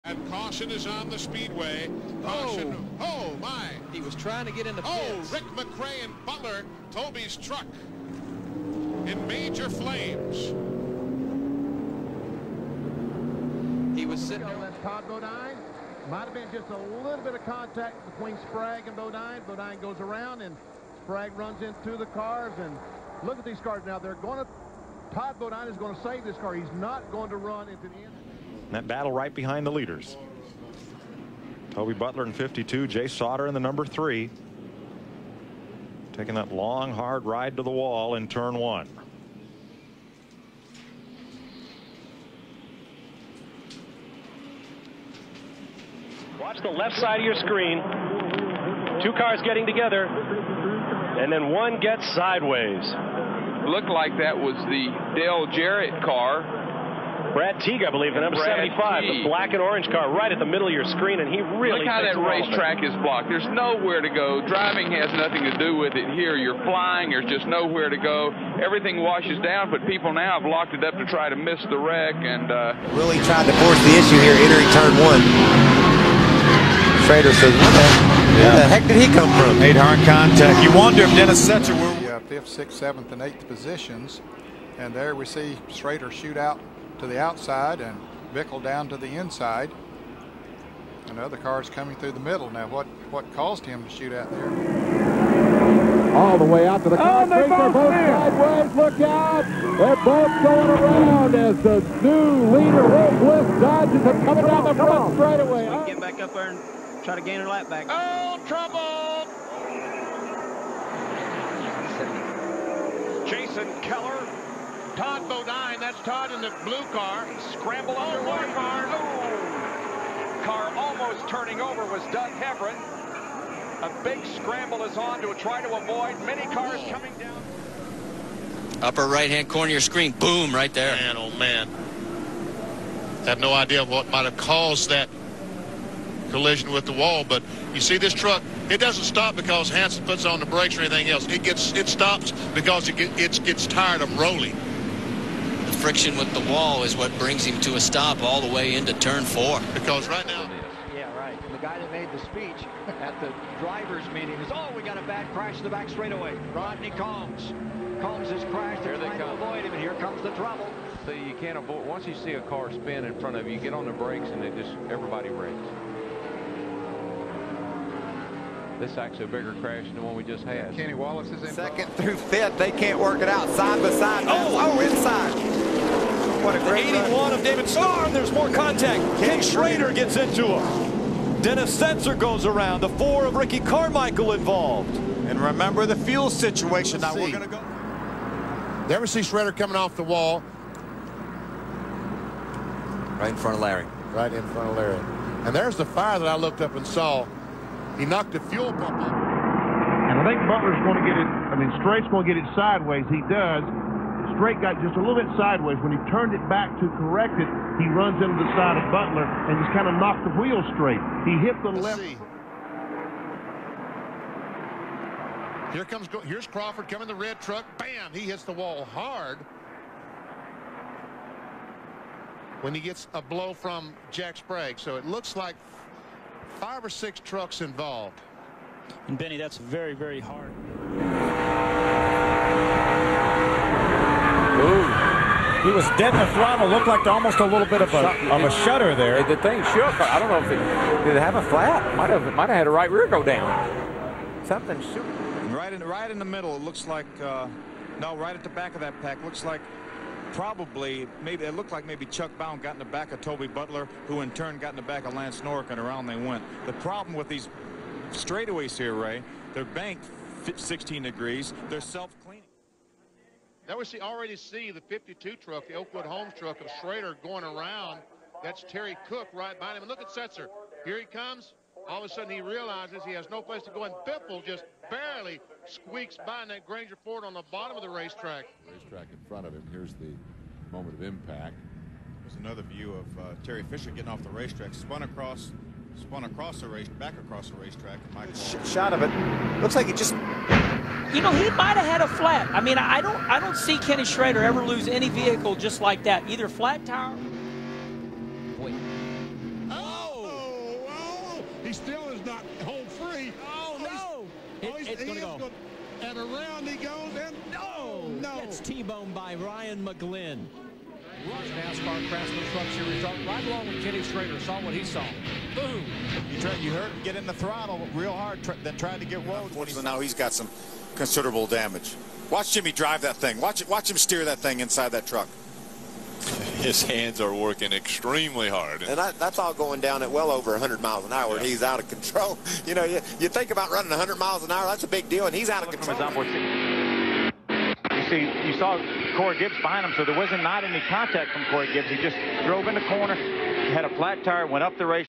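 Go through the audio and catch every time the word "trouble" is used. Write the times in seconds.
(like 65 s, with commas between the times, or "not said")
108 s, 160 s.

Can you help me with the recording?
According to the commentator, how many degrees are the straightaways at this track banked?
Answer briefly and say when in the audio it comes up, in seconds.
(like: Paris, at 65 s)
16, at 260 s.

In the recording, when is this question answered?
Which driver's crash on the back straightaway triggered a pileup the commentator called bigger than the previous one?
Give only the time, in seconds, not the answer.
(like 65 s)
156 s.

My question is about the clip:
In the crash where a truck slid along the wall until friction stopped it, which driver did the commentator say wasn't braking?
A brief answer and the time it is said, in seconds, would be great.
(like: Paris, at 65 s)
Hanson, at 139 s.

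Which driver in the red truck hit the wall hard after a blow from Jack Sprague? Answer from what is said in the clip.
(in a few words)
Crawford.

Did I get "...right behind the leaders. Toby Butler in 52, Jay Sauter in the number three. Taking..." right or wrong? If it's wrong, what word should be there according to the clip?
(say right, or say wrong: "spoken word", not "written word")
right.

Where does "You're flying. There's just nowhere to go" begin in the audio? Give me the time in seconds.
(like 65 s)
66 s.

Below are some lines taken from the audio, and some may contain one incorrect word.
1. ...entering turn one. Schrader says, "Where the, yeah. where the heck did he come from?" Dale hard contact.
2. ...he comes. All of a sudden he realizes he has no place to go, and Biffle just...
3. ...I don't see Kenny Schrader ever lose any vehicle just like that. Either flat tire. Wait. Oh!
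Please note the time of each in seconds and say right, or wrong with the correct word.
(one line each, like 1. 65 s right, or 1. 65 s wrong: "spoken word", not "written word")
1. 74 s wrong: "Made", not "Dale"
2. 270 s right
3. 293 s right.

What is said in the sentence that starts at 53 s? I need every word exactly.
Looked like that was the Dale Jarrett car Brad Teague, I believe, the number Brad 75, Teague.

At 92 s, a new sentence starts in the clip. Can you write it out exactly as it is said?
Now, what, what caused him to shoot out there?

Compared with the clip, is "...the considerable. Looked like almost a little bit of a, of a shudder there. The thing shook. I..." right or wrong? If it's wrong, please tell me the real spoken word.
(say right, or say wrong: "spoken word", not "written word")
wrong: "throttle", not "considerable".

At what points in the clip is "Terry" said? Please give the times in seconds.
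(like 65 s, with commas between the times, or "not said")
268 s, 283 s.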